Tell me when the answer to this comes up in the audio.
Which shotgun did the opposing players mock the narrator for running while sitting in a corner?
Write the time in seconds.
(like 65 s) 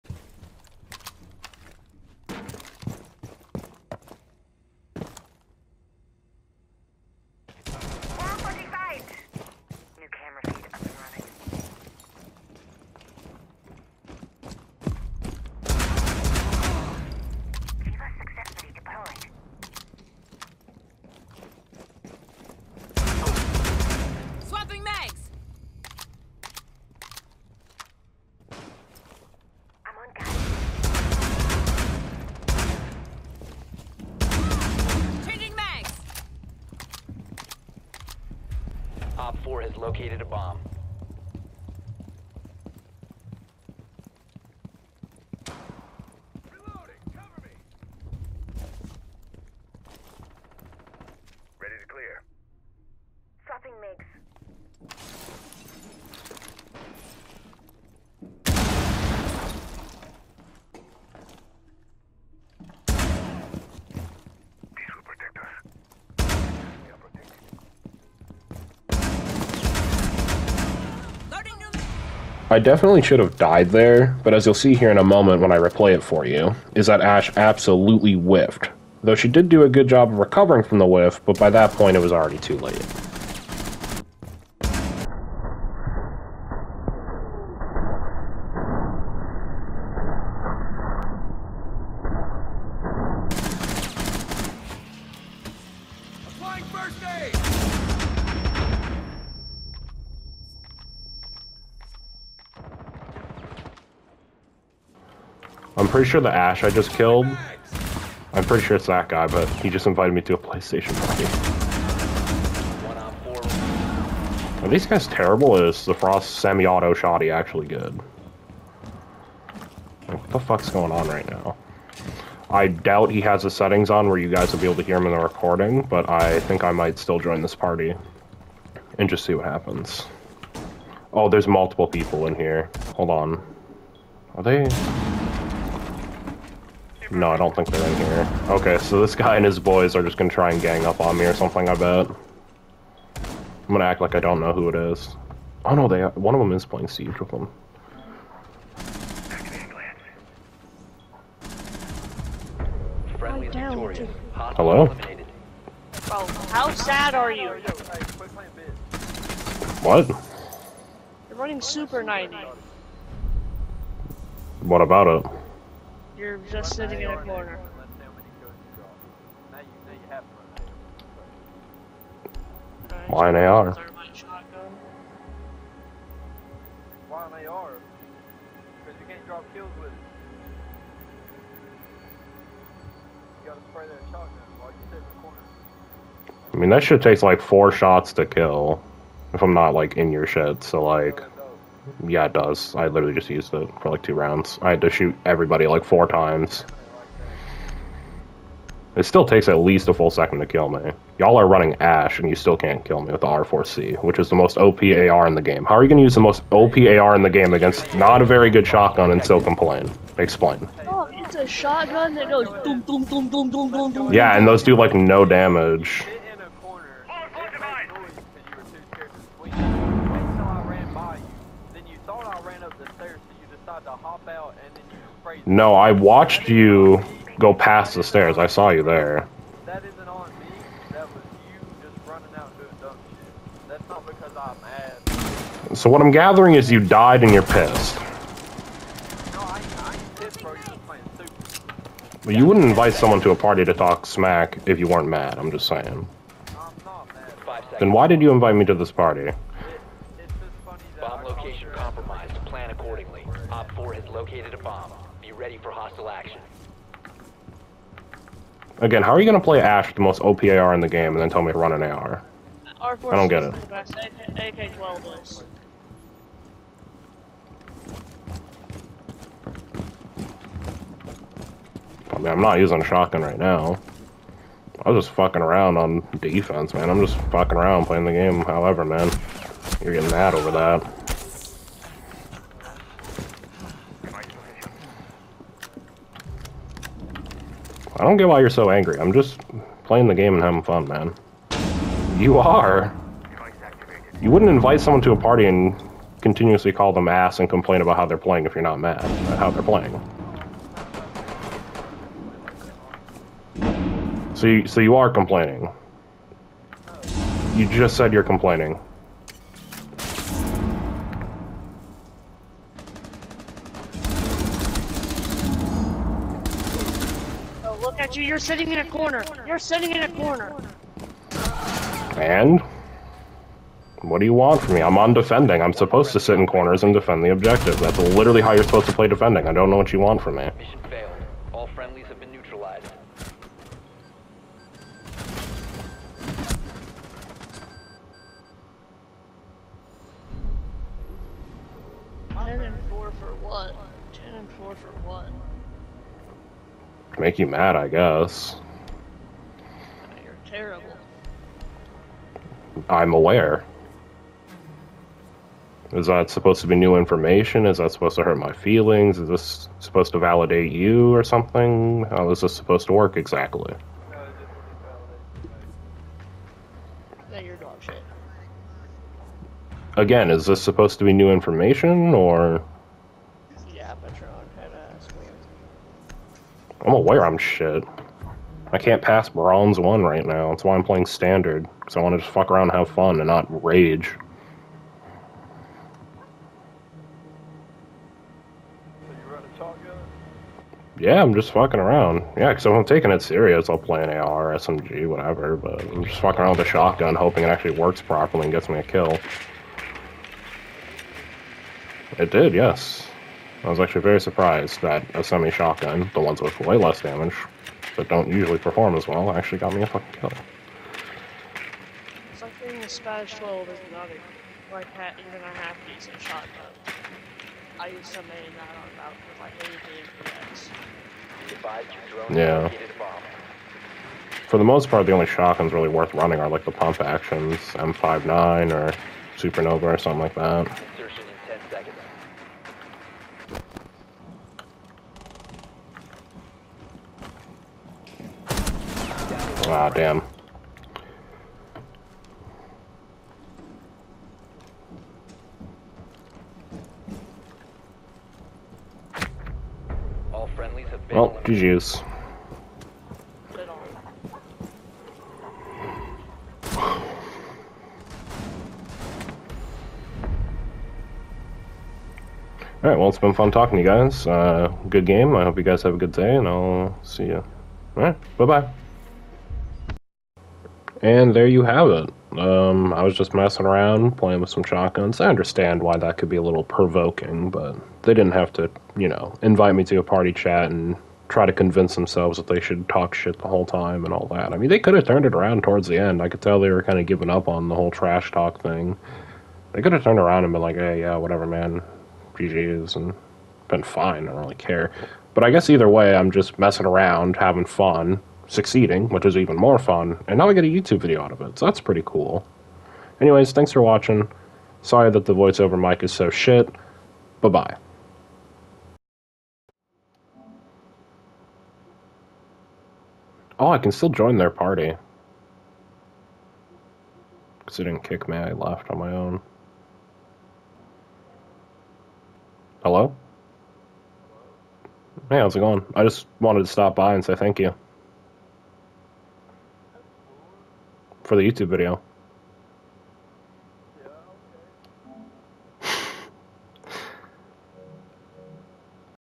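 161 s.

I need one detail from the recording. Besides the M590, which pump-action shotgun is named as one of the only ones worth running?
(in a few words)
Supernova.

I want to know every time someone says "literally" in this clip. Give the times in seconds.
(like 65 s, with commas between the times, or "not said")
192 s, 327 s.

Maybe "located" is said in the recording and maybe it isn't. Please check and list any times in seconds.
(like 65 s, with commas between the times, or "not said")
39 s, 254 s.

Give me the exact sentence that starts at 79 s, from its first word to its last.
Though she did do a good job of recovering from the whiff, but by that point it was already too late.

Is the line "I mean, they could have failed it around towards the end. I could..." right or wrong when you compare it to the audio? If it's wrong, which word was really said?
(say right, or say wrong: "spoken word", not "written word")
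wrong: "turned", not "failed".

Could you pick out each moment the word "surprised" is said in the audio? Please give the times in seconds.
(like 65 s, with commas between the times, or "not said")
404 s.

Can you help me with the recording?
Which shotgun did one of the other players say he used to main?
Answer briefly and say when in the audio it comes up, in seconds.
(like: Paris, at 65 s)
SPAS-12, at 412 s.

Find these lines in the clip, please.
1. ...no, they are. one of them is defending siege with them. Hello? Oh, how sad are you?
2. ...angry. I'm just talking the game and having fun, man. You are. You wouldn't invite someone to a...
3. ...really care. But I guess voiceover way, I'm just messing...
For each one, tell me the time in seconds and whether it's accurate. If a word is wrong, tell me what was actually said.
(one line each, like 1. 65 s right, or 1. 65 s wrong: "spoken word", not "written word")
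1. 145 s wrong: "playing", not "defending"
2. 288 s wrong: "playing", not "talking"
3. 494 s wrong: "either", not "voiceover".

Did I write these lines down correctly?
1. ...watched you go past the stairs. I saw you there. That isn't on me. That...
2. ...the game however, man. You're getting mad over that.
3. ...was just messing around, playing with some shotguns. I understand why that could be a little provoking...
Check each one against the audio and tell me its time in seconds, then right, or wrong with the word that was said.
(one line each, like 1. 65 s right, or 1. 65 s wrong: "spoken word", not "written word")
1. 225 s right
2. 278 s right
3. 473 s right.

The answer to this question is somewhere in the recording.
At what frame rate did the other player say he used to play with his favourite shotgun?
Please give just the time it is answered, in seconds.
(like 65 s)
420 s.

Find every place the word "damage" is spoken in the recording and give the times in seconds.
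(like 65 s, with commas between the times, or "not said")
215 s, 407 s.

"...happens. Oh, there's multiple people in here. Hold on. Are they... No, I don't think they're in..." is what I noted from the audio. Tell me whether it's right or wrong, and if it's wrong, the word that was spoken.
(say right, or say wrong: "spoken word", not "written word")
right.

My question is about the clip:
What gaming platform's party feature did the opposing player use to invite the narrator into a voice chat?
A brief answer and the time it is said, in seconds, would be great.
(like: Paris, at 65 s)
PlayStation, at 110 s.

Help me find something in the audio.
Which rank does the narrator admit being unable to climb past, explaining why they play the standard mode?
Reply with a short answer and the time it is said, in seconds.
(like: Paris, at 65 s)
Bronze 1, at 379 s.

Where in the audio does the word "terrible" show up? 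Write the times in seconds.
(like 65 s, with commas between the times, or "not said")
115 s, 350 s.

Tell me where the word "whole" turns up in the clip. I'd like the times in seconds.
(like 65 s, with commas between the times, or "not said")
483 s, 487 s.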